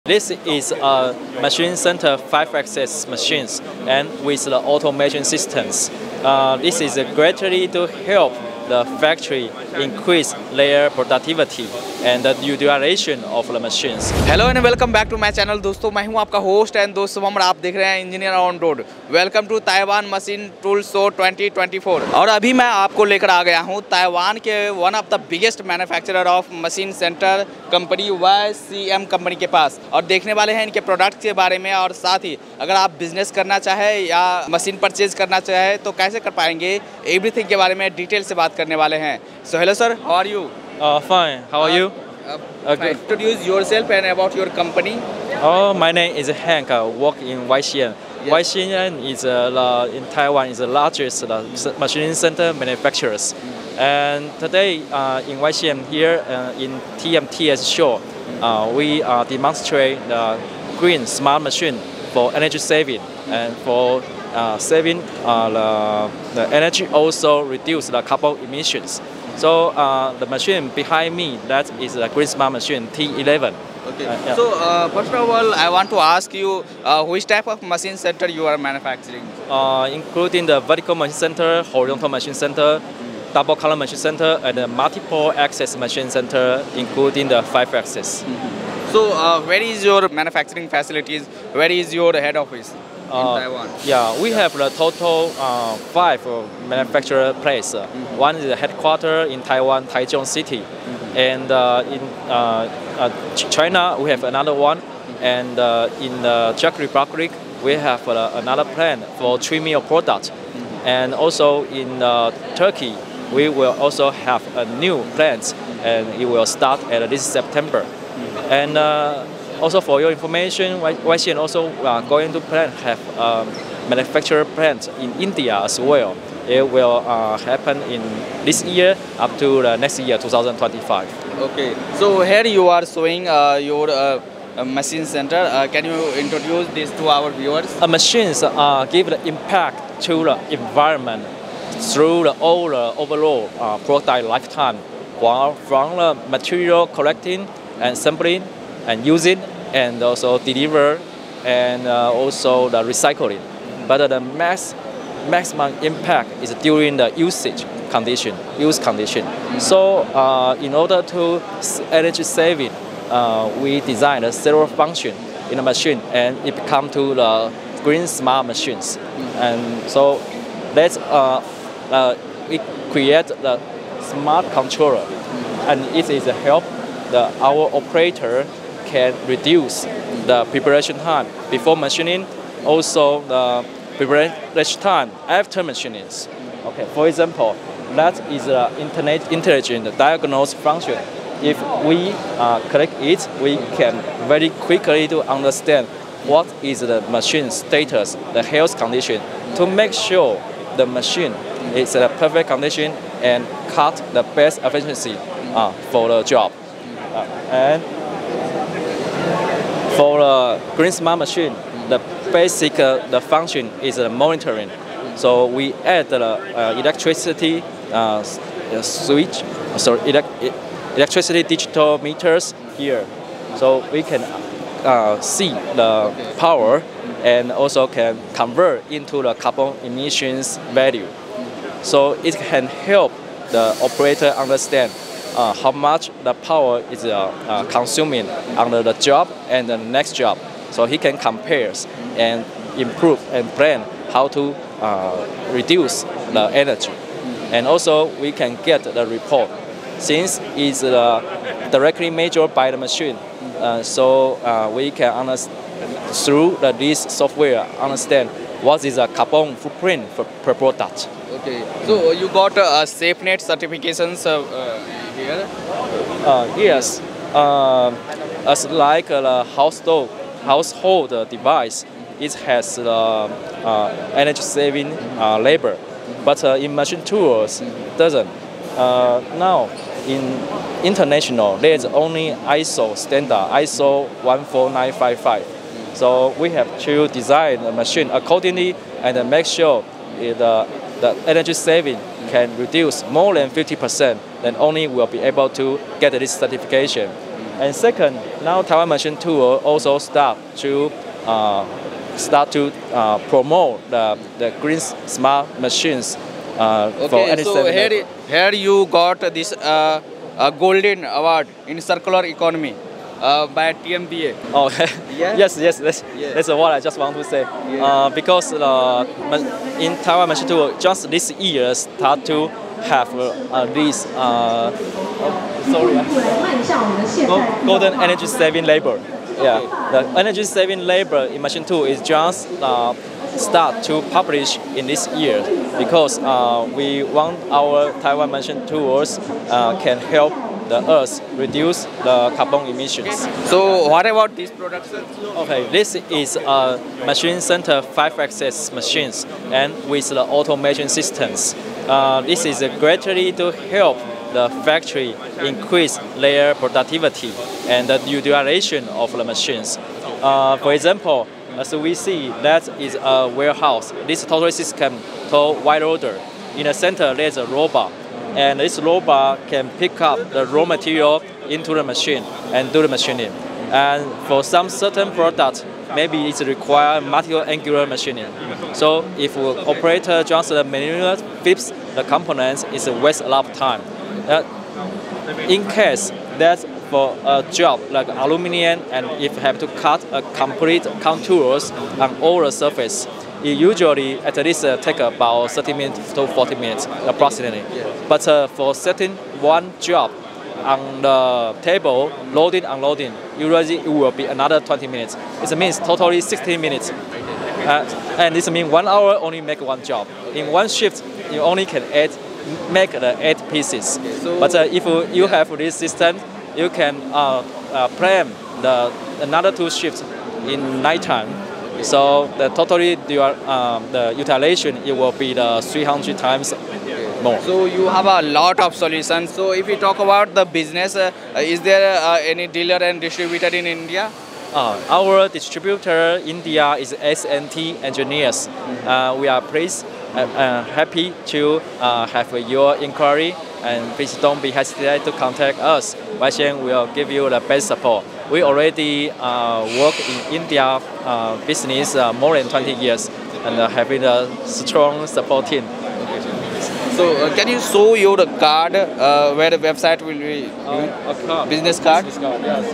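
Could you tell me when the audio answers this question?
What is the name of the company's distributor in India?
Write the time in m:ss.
7:17.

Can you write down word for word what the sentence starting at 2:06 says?
It will uh, happen in this year up to the next year, 2025.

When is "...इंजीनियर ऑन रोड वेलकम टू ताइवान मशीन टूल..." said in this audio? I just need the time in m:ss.
0:18.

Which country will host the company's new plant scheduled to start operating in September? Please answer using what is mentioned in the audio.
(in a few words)
Turkey.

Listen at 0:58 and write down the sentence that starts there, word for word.
we demonstrate the green smart machine for energy saving mm.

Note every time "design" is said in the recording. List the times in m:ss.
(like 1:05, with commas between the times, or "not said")
2:43, 4:47.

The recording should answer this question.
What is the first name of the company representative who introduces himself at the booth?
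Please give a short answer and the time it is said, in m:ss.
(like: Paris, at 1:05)
Hank, at 0:46.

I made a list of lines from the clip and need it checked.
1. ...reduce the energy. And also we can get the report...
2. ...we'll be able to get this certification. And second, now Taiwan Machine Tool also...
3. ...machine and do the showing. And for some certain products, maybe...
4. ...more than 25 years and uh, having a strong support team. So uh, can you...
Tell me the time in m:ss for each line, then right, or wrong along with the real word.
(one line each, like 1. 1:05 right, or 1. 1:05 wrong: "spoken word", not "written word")
1. 4:05 right
2. 4:54 right
3. 6:11 wrong: "machining", not "showing"
4. 7:32 wrong: "20", not "25".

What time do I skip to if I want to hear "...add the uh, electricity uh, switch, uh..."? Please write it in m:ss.
3:35.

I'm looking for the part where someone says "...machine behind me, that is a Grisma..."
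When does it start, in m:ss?
1:10.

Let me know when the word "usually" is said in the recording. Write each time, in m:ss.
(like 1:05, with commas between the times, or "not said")
6:33, 6:43.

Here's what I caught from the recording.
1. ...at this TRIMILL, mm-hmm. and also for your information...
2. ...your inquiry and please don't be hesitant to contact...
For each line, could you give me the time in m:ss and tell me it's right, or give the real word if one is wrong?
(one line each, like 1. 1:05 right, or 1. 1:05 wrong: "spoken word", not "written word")
1. 1:56 wrong: "September", not "TRIMILL"
2. 7:22 right.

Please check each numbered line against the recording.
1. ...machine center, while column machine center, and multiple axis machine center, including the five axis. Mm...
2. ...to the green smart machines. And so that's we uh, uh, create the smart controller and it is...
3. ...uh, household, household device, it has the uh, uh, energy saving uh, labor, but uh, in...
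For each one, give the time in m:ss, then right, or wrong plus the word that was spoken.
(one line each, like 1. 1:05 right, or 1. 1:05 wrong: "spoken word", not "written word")
1. 1:22 wrong: "double", not "while"
2. 2:46 right
3. 4:29 right.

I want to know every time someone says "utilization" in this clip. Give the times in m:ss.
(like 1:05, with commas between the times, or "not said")
5:58, 7:04.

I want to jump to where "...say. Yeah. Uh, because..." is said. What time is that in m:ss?
5:17.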